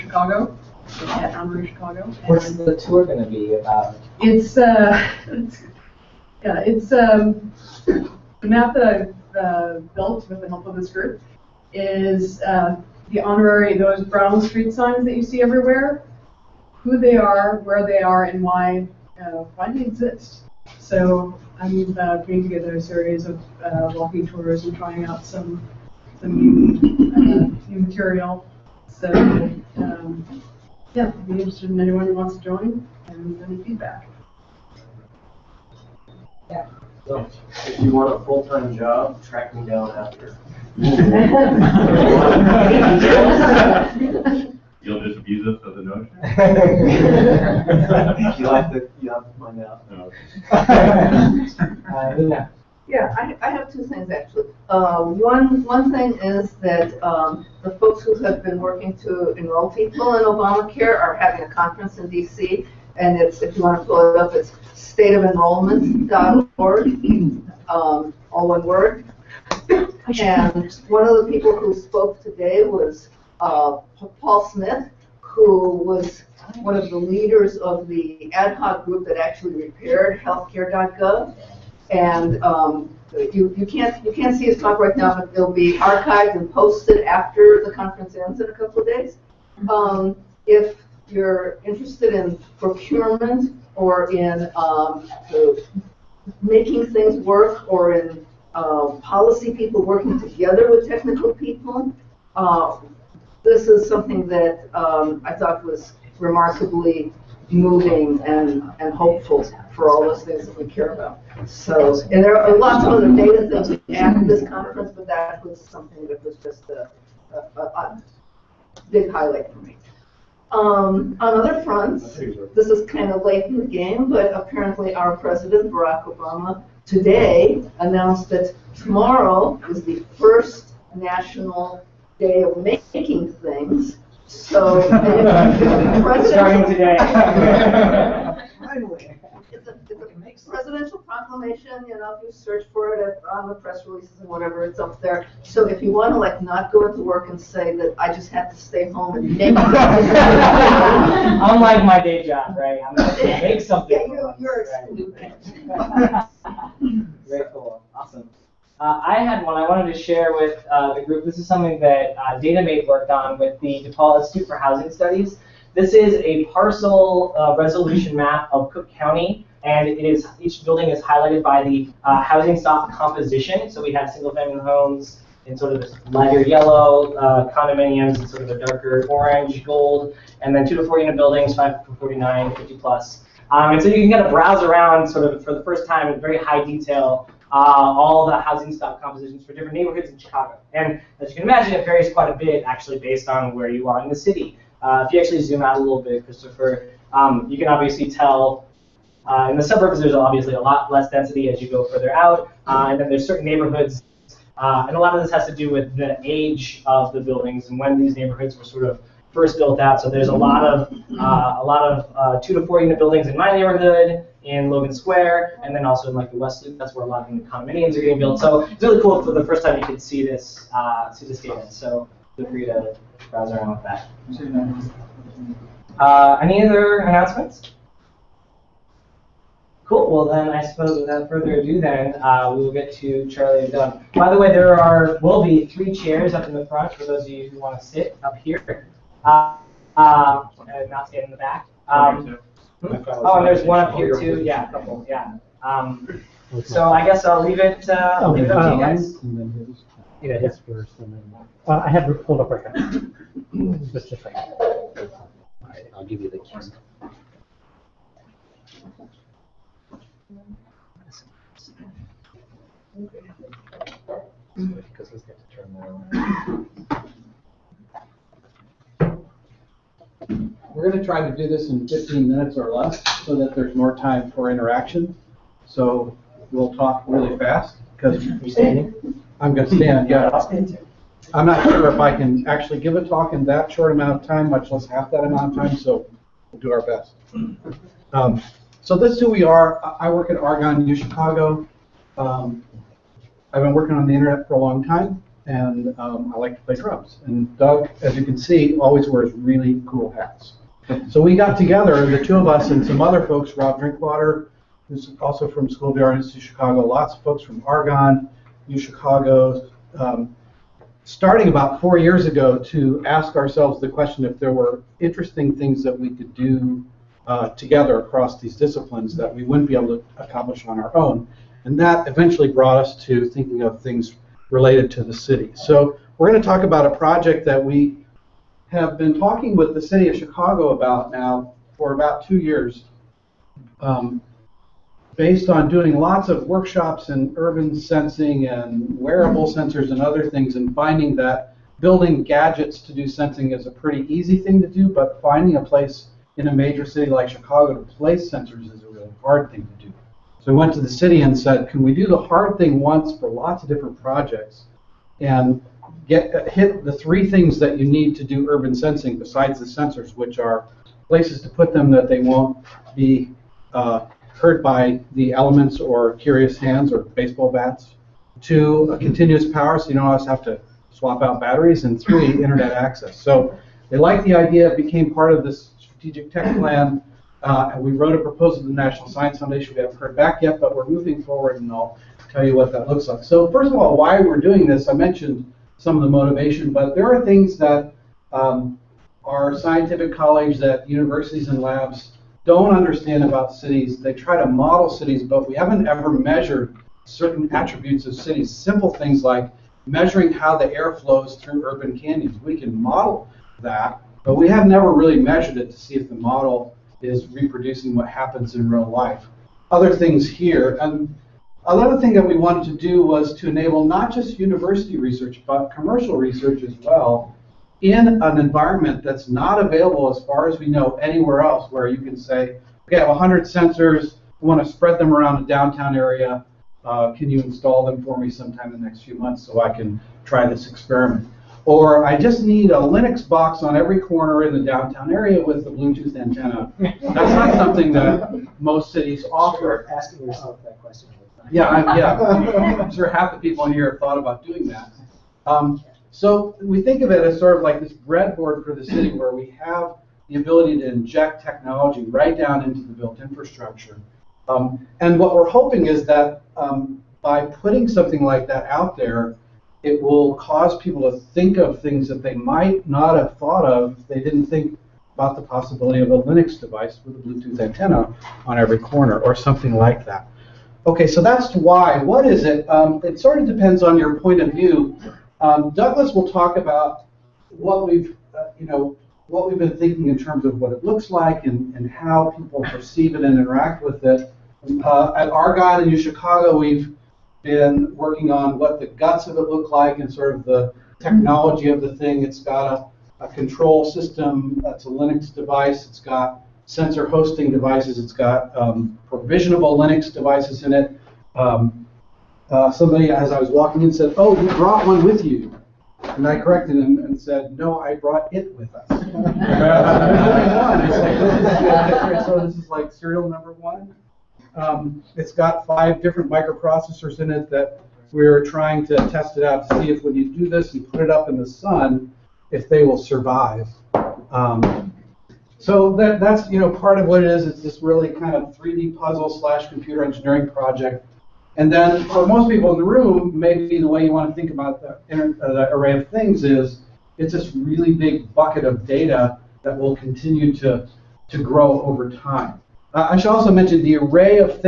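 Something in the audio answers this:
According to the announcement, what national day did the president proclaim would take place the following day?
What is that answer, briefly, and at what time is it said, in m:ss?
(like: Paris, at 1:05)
national day of making, at 2:10.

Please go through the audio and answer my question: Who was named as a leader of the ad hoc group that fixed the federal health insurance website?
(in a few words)
Paul Smith.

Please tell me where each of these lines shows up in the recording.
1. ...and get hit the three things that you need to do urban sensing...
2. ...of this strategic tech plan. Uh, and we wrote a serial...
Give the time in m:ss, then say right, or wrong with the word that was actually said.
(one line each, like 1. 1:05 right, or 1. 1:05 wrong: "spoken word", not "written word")
1. 5:55 right
2. 6:15 wrong: "proposal", not "serial".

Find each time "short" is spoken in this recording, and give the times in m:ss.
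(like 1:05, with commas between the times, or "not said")
4:43.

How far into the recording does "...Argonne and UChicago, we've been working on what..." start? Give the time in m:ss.
8:05.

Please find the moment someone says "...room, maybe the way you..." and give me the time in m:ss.
8:52.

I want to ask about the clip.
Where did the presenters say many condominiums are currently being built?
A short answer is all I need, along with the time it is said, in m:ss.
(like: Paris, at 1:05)
West Loop, at 3:36.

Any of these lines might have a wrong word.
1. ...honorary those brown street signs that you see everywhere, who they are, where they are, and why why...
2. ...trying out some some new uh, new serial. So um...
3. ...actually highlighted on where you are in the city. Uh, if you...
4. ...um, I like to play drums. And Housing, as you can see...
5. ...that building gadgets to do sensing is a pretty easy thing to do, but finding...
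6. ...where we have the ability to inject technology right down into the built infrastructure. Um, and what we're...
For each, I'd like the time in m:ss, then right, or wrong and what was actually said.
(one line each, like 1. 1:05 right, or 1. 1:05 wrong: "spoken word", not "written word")
1. 0:13 right
2. 0:24 wrong: "material", not "serial"
3. 3:12 wrong: "based", not "highlighted"
4. 4:55 wrong: "Doug", not "Housing"
5. 5:41 right
6. 7:29 right.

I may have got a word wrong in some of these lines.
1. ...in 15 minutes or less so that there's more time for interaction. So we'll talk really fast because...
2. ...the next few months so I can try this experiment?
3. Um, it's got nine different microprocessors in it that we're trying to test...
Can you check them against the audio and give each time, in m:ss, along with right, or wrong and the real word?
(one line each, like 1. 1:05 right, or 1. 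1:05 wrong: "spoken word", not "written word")
1. 4:31 right
2. 7:08 right
3. 8:34 wrong: "five", not "nine".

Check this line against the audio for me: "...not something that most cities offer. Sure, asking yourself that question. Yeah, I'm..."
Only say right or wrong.
right.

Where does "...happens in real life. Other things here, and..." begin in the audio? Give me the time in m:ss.
6:48.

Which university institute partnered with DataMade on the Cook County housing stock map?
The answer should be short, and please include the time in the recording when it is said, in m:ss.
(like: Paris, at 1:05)
DePaul Institute for Housing Studies, at 2:43.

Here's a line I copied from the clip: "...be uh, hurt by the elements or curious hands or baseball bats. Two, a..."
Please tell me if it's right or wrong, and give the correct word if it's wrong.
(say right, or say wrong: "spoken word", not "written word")
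right.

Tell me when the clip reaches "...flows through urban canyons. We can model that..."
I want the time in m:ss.
6:40.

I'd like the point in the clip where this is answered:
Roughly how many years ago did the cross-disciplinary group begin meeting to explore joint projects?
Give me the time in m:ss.
5:11.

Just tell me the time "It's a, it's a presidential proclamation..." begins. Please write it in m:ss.
2:16.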